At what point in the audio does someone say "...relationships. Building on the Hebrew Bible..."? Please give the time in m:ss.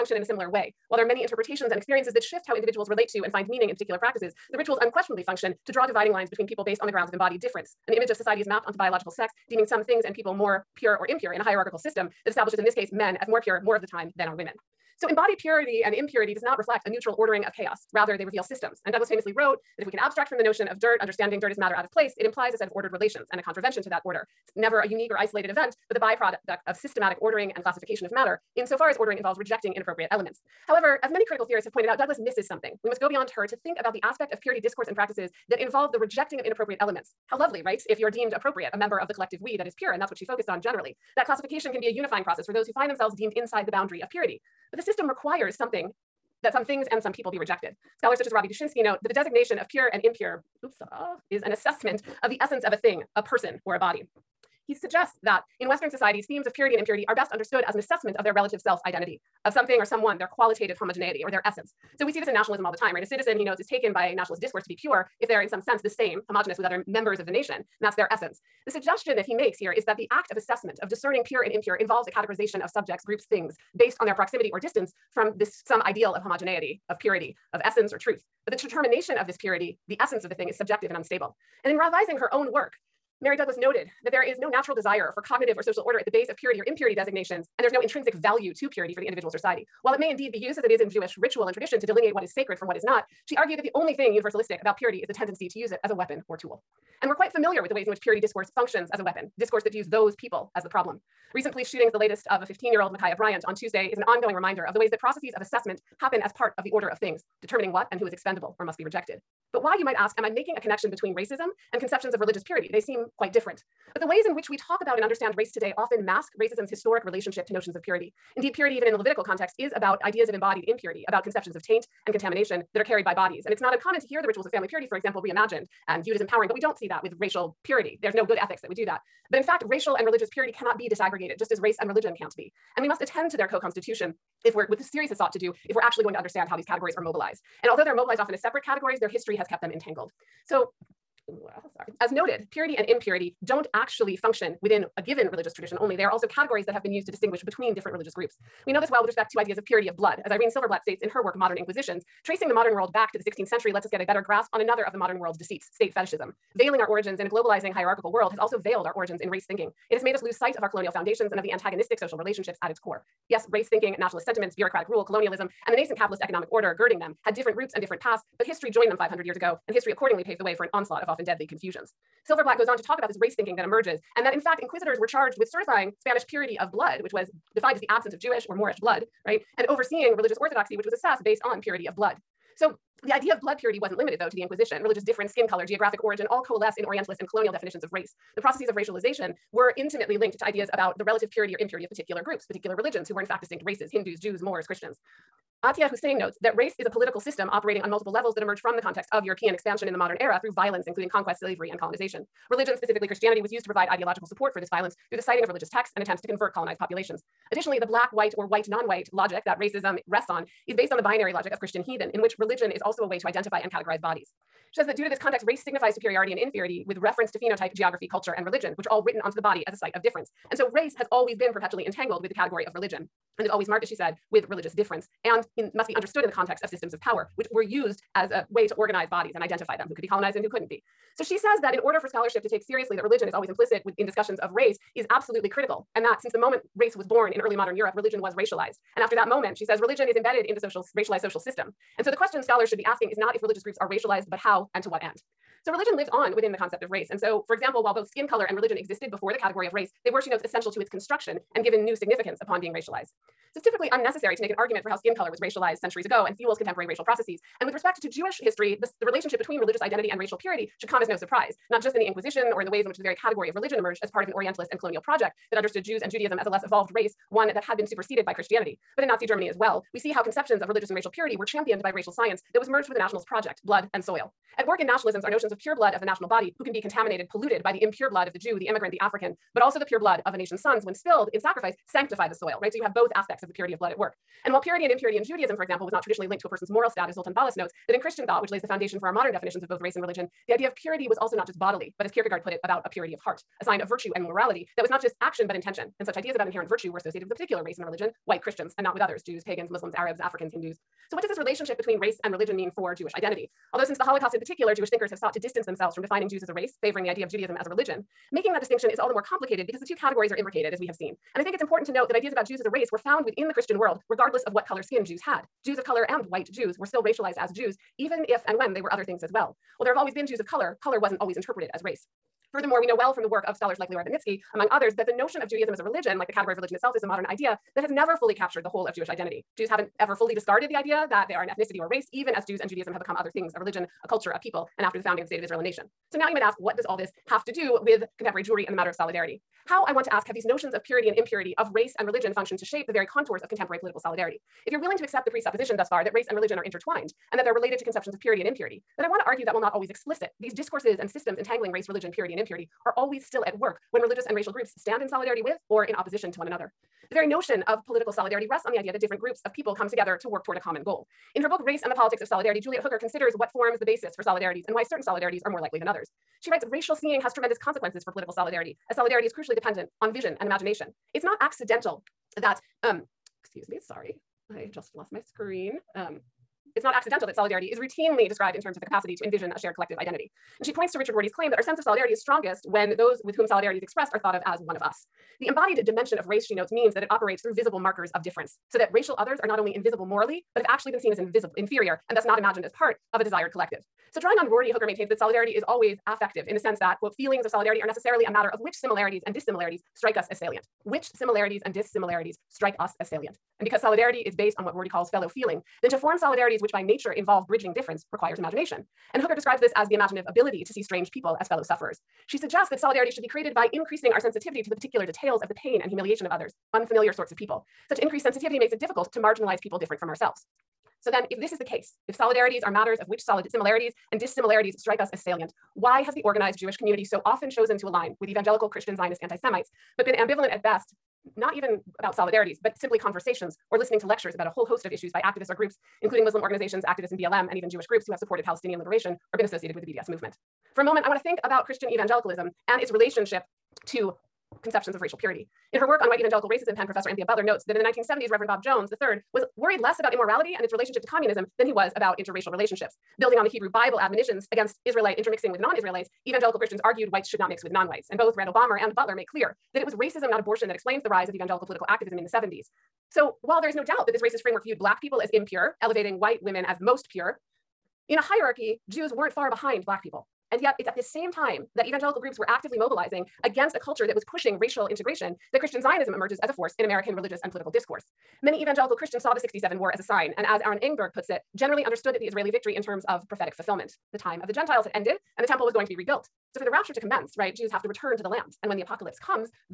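7:32.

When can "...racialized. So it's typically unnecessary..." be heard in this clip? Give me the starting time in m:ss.
4:12.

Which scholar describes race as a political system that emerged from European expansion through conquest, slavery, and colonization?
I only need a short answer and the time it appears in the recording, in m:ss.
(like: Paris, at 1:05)
Atiya Husain, at 3:15.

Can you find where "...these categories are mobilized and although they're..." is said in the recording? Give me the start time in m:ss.
2:16.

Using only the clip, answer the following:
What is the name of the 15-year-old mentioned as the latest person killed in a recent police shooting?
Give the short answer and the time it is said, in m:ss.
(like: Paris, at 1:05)
Ma'Khia Bryant, at 1:42.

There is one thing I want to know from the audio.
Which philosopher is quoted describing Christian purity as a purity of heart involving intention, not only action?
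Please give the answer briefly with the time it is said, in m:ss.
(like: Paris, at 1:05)
Kierkegaard, at 4:52.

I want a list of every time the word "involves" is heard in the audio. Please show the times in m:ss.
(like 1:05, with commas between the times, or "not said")
0:29, 0:35, 1:11, 6:47.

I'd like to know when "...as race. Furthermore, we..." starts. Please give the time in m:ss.
5:21.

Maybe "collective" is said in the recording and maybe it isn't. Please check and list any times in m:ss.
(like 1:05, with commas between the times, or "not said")
0:39, 6:19, 6:33.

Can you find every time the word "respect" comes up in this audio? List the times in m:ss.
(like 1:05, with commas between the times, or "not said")
2:29, 4:17.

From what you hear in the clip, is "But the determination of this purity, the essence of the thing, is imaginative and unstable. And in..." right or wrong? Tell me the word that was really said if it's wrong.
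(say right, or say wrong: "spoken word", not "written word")
wrong: "subjective", not "imaginative".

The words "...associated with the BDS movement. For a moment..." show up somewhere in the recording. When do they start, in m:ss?
7:19.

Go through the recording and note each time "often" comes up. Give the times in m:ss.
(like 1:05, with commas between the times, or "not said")
1:55, 2:18, 2:51, 7:07.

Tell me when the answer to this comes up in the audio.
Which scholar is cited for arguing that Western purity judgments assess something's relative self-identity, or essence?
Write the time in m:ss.
0:48.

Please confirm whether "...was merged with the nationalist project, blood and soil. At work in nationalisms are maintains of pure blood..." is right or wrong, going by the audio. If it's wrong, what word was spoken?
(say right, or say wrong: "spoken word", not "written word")
wrong: "notions", not "maintains".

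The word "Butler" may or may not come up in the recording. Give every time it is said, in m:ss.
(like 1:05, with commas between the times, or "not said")
7:27, 7:38.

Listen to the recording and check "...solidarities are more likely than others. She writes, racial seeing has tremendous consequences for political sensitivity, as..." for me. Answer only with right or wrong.
wrong.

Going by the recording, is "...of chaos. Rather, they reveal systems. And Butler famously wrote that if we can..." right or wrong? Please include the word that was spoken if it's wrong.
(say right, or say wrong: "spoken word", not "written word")
wrong: "Douglas", not "Butler".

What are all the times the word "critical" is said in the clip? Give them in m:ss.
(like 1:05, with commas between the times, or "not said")
0:31, 3:55.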